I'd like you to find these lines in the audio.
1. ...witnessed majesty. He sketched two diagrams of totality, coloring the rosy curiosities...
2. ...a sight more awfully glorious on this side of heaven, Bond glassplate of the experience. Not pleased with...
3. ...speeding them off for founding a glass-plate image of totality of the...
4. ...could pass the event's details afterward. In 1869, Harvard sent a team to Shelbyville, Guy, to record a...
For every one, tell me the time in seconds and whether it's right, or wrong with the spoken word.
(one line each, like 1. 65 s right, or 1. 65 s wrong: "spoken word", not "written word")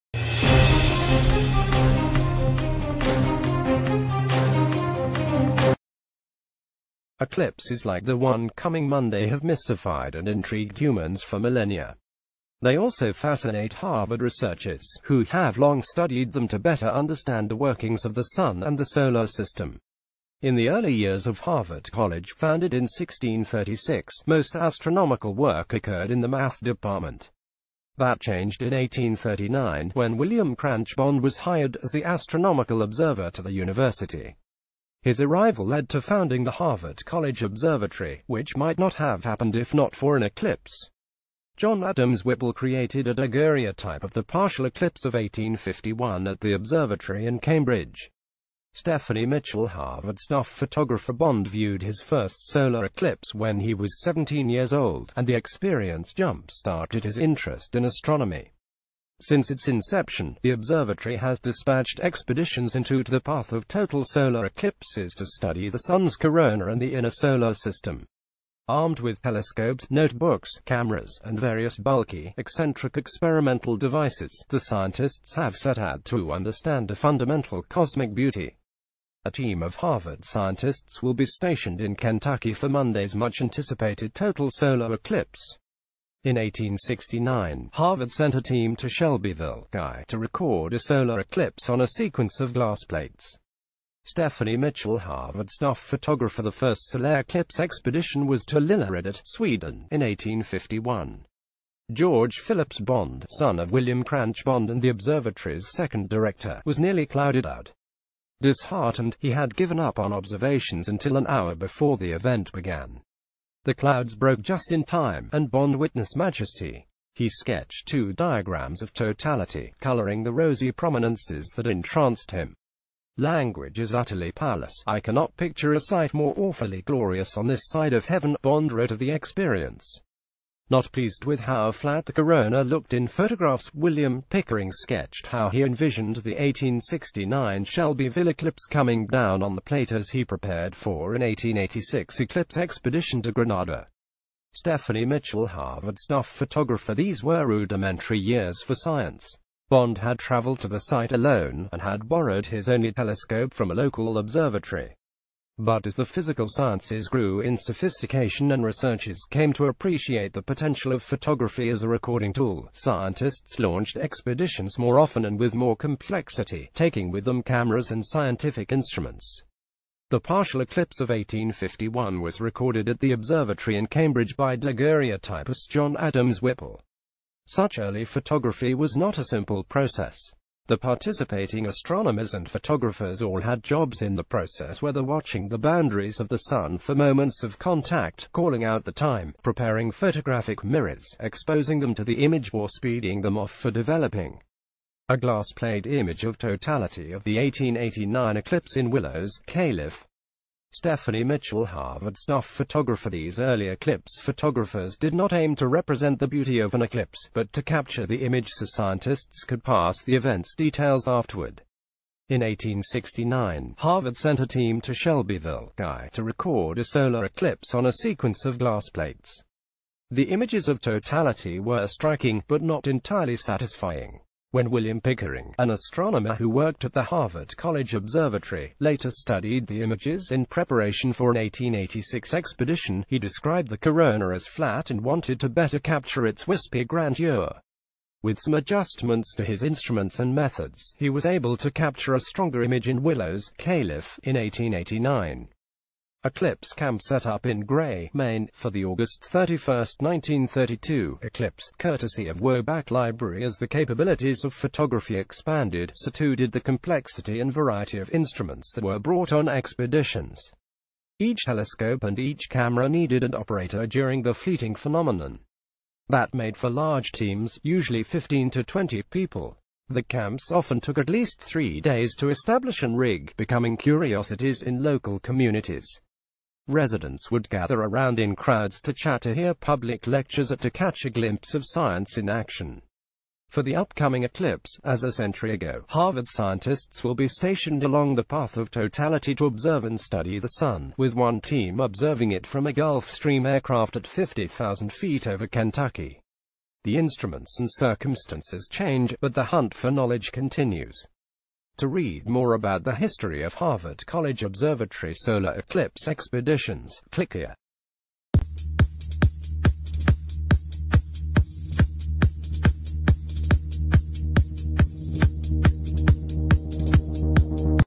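1. 115 s wrong: "prominences", not "curiosities"
2. 125 s wrong: "wrote", not "glassplate"
3. 192 s wrong: "developing", not "founding"
4. 209 s right.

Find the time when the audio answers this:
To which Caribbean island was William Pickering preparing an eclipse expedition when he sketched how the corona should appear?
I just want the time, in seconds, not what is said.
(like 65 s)
143 s.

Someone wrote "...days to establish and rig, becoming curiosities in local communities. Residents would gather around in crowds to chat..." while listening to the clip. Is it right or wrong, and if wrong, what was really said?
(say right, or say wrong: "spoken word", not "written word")
right.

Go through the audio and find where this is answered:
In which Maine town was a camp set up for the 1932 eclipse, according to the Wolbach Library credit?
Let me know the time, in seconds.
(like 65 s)
247 s.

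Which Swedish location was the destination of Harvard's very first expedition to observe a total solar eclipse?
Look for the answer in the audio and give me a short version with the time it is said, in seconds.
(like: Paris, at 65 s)
Lilla Edet, at 98 s.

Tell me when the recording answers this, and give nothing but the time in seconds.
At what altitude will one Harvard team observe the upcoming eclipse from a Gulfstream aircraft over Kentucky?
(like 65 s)
294 s.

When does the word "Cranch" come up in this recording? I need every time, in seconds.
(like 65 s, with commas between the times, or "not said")
30 s, 104 s.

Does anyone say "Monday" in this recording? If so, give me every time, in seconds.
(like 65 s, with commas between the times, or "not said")
8 s, 82 s.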